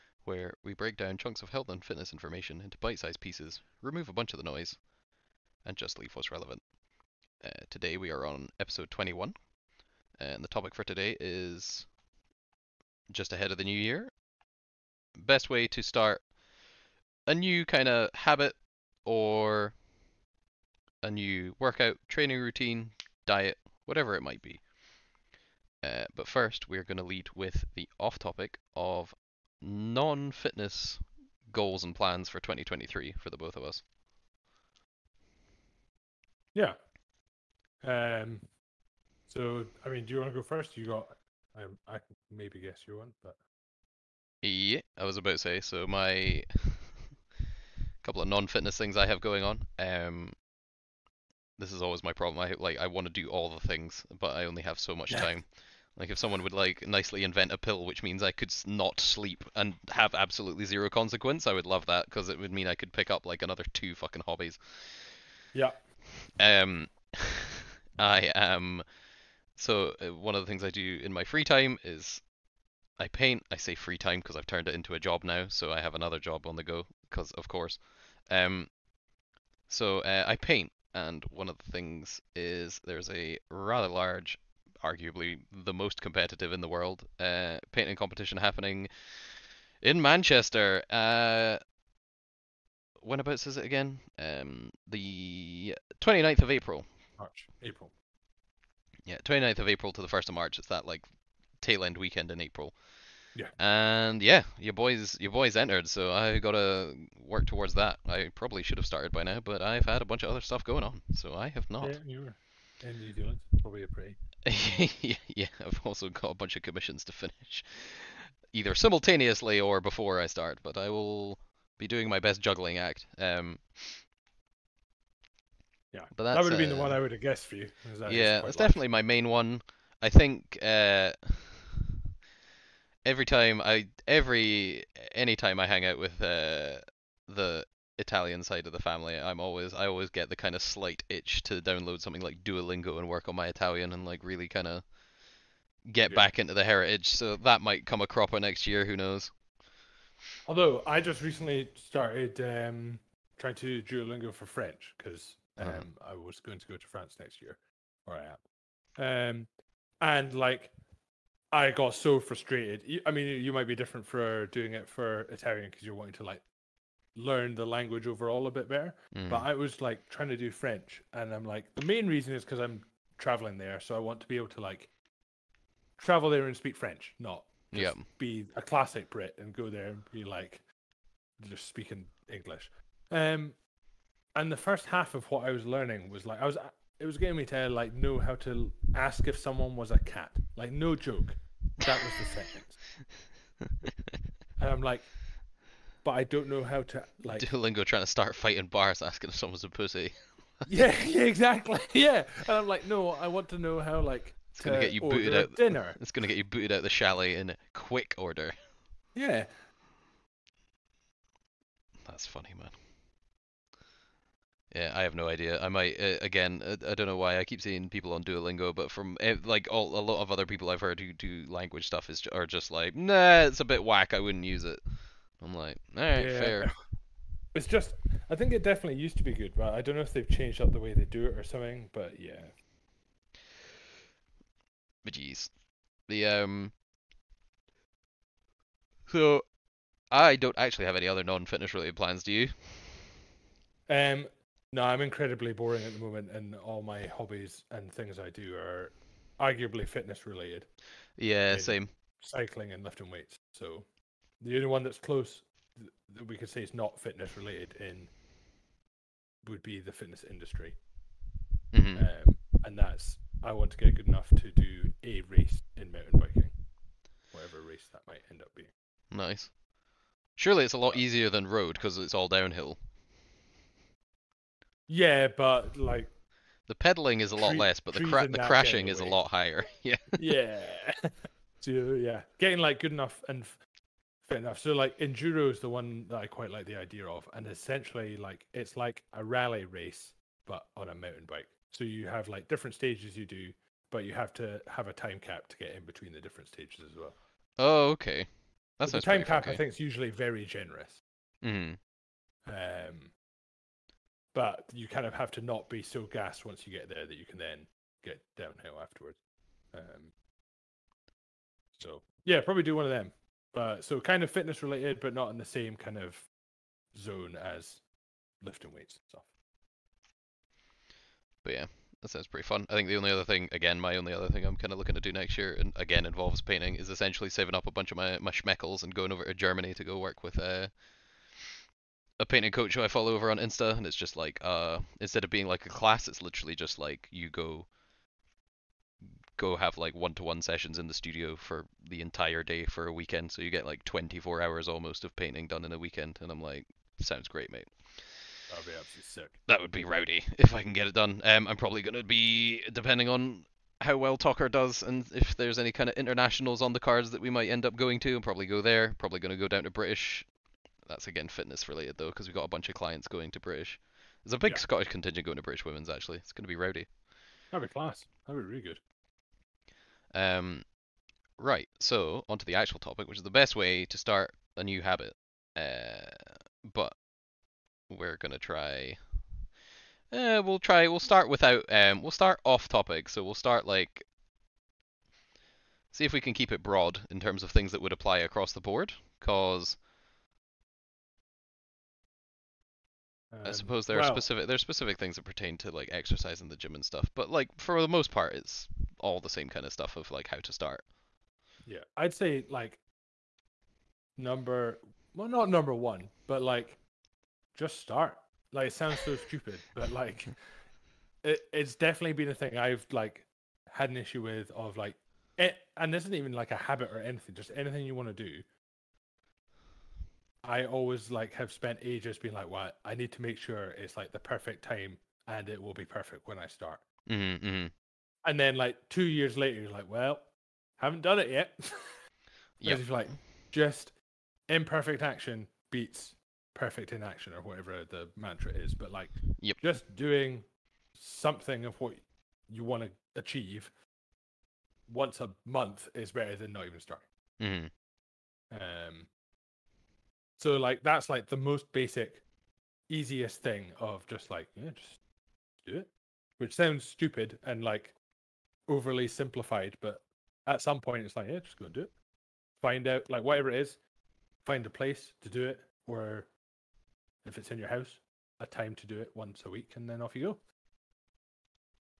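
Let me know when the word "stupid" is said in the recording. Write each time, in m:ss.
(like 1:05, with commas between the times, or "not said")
6:49, 7:36.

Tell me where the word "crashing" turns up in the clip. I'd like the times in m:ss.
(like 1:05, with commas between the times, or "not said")
4:38.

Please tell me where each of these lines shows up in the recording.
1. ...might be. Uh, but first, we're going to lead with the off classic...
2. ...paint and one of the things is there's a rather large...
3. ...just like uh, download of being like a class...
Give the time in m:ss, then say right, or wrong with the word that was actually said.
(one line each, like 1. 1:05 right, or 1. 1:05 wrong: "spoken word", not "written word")
1. 0:24 wrong: "topic", not "classic"
2. 1:20 right
3. 5:33 wrong: "instead", not "download".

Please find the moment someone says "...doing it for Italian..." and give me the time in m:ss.
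2:44.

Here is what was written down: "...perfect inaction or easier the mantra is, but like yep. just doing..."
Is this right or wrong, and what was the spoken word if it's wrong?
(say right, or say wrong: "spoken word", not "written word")
wrong: "whatever", not "easier".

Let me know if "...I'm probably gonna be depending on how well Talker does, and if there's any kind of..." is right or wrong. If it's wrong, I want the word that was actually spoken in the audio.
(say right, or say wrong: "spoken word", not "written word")
right.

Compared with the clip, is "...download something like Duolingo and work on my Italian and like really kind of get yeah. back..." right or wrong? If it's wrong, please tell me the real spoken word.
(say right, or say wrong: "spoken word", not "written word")
right.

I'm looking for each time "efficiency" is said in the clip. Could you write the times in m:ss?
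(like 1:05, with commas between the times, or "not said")
not said.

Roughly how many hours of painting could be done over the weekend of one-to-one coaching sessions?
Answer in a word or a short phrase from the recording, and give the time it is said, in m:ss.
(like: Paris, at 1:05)
24, at 5:43.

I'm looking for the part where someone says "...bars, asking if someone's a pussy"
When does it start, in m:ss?
3:18.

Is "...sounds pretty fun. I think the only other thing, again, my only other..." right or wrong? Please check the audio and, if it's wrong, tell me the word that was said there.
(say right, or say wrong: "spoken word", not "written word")
right.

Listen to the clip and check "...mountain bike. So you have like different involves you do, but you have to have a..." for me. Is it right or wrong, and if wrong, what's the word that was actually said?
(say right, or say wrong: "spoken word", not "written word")
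wrong: "stages", not "involves".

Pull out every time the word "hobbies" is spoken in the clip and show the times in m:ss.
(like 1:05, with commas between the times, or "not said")
1:04, 4:07.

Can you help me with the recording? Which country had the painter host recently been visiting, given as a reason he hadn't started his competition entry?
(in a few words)
New Zealand.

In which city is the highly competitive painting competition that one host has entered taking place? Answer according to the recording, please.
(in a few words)
Manchester.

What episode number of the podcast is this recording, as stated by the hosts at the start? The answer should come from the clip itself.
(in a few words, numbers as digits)
21.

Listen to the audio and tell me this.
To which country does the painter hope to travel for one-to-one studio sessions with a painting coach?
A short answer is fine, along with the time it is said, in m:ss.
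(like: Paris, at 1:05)
Germany, at 5:29.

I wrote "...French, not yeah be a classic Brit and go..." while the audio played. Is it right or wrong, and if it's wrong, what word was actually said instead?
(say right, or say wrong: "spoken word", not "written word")
right.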